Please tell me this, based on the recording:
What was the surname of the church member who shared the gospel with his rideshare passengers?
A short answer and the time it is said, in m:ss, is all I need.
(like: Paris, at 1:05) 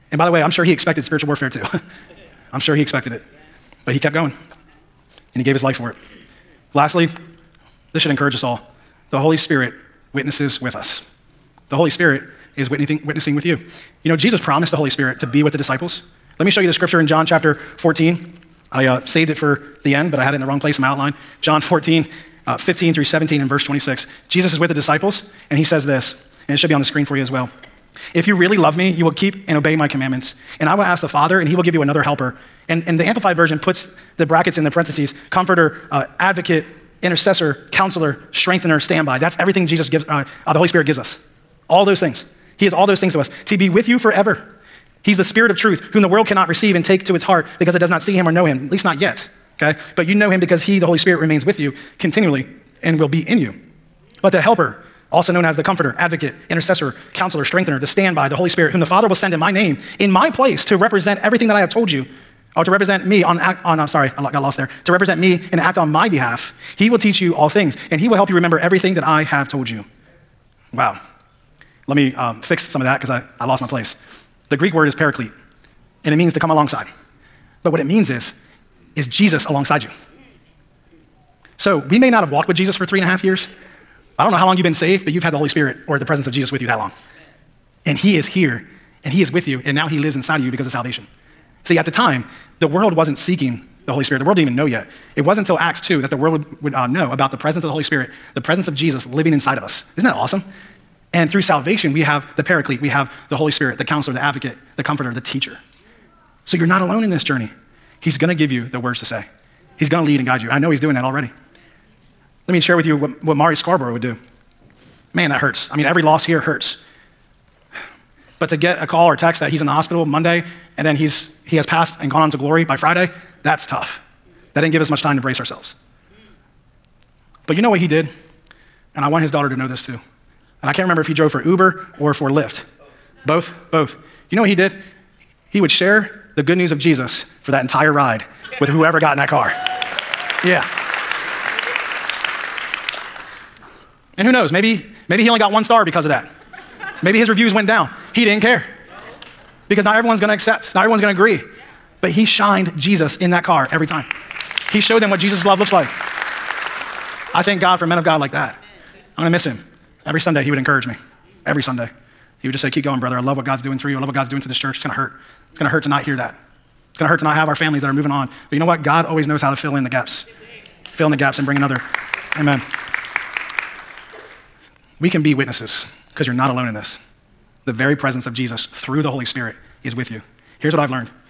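Scarborough, at 1:53.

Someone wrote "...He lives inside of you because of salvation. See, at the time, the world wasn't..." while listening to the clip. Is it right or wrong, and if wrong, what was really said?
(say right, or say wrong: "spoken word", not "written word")
right.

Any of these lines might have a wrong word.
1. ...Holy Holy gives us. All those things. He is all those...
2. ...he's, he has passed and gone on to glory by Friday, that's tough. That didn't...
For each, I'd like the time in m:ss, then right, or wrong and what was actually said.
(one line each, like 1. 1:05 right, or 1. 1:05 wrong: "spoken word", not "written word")
1. 0:40 wrong: "Spirit", not "Holy"
2. 2:00 right.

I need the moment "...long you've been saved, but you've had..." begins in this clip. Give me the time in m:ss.
1:24.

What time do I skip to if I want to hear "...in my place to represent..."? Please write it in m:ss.
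0:59.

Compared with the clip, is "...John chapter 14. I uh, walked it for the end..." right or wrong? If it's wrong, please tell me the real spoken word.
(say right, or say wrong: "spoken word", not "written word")
wrong: "saved", not "walked".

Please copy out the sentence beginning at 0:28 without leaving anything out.
If you really love me, you will keep and obey my commandments.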